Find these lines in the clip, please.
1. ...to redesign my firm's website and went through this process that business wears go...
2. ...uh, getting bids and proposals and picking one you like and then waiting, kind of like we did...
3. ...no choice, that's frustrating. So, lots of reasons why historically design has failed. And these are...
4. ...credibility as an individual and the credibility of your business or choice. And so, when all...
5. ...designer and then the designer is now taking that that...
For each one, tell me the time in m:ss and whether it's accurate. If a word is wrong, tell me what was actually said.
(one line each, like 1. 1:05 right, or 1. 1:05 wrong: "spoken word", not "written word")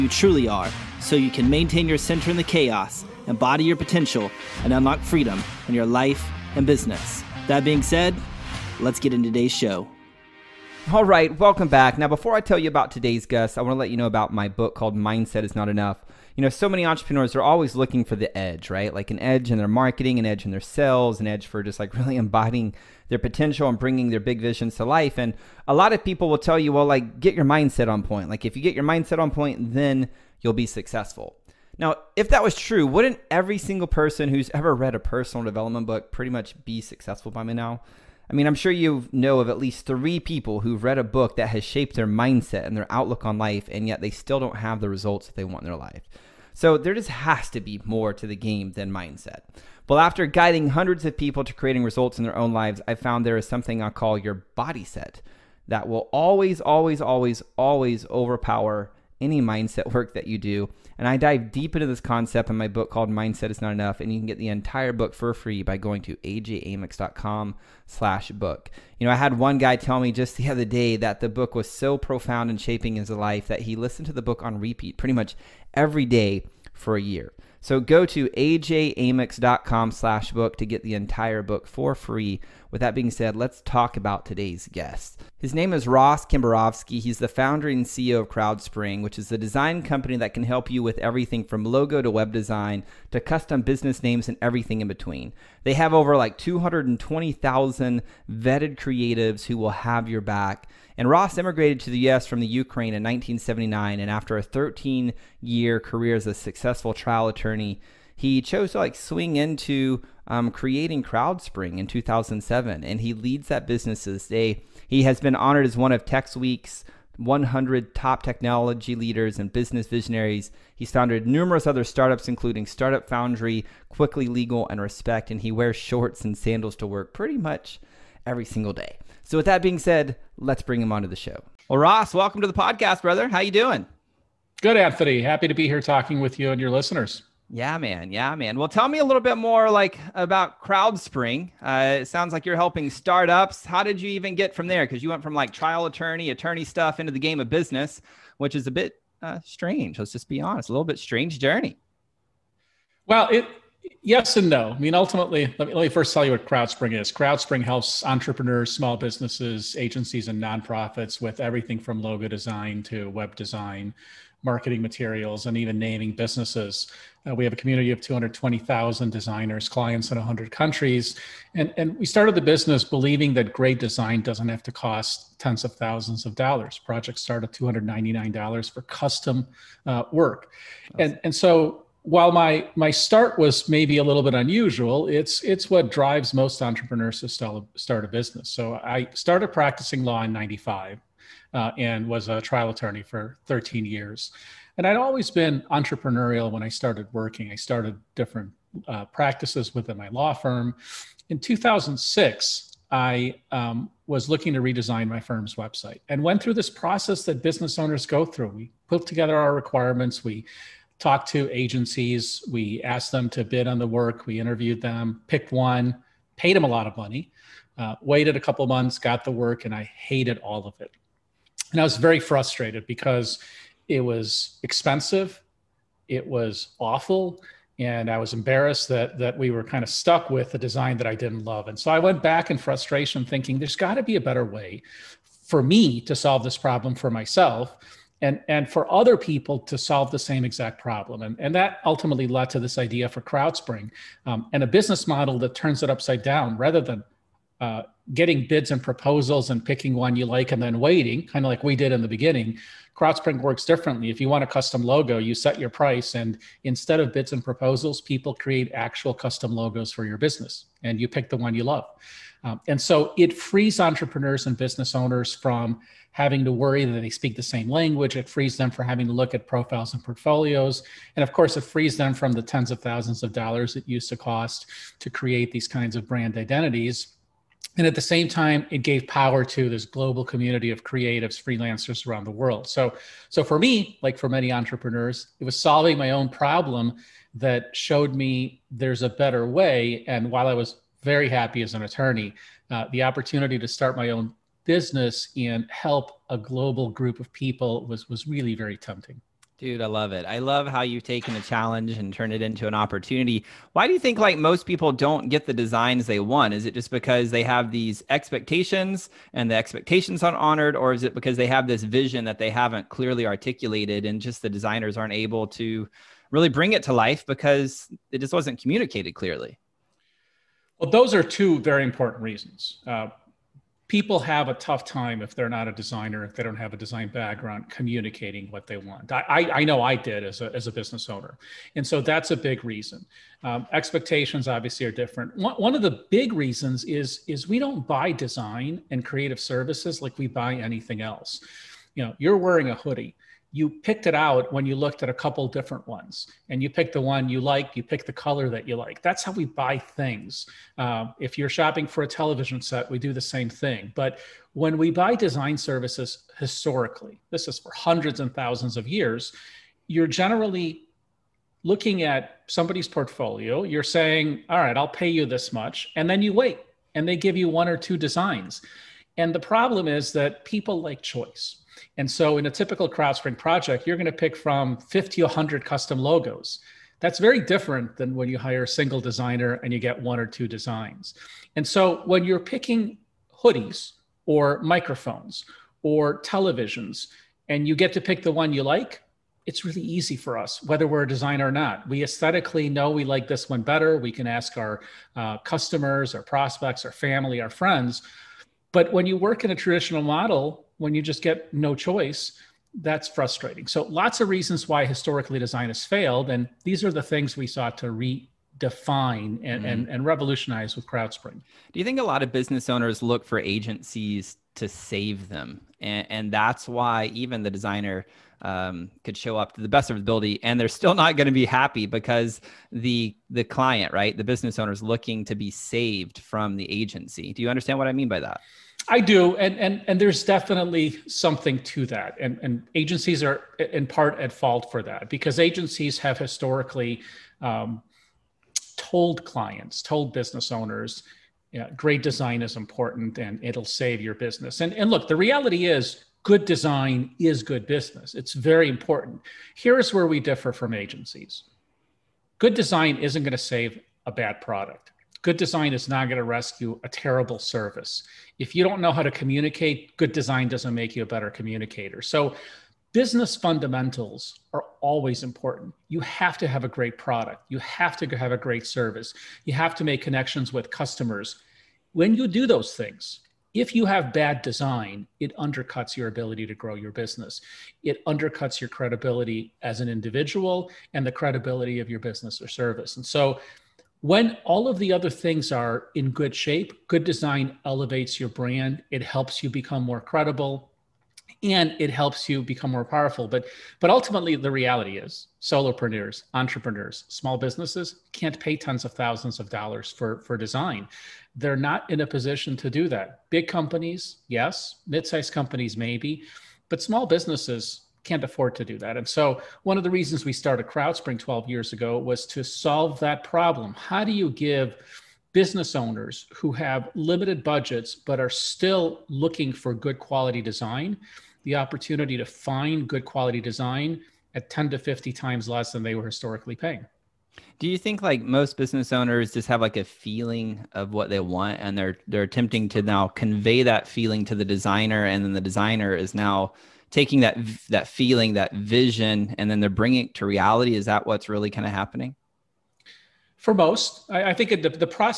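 1. 3:24 wrong: "owners", not "wears"
2. 4:07 right
3. 6:41 right
4. 7:58 wrong: "service", not "choice"
5. 8:54 right.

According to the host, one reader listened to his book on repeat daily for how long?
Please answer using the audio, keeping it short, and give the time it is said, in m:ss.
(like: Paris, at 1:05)
a year, at 1:16.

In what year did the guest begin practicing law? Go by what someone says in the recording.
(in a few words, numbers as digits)
1995.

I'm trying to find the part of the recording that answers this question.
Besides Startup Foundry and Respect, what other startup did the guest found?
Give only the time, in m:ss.
2:03.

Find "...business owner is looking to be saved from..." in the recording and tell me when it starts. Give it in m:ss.
7:04.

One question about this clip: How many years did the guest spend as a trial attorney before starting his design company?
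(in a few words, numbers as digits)
13.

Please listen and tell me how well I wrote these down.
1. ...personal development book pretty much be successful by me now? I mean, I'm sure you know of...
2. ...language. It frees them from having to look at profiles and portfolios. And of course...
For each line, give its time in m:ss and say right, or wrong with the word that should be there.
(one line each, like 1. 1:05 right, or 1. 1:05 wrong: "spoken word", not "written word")
1. 0:34 right
2. 4:27 right.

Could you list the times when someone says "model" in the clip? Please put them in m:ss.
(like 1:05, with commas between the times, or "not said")
4:05, 6:40.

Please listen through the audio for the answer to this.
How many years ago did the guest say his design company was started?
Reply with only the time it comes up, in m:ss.
8:31.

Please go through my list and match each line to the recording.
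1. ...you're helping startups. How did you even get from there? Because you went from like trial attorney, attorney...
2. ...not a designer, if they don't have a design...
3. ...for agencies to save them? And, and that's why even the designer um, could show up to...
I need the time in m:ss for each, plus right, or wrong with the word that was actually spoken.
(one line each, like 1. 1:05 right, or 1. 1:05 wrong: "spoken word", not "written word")
1. 2:22 right
2. 5:25 right
3. 6:53 right.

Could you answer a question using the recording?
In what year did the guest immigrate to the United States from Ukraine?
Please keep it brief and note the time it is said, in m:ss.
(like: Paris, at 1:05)
1979, at 1:43.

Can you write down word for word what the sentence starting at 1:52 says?
And he leads that business to this day.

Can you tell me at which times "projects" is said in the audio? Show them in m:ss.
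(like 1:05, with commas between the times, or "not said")
2:56, 6:13.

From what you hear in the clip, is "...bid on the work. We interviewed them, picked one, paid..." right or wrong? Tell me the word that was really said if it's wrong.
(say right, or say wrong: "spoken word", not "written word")
right.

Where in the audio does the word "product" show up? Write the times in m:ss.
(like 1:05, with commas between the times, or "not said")
7:34, 7:46.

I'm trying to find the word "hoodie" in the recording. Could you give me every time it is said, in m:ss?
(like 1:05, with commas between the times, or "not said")
5:42, 6:23.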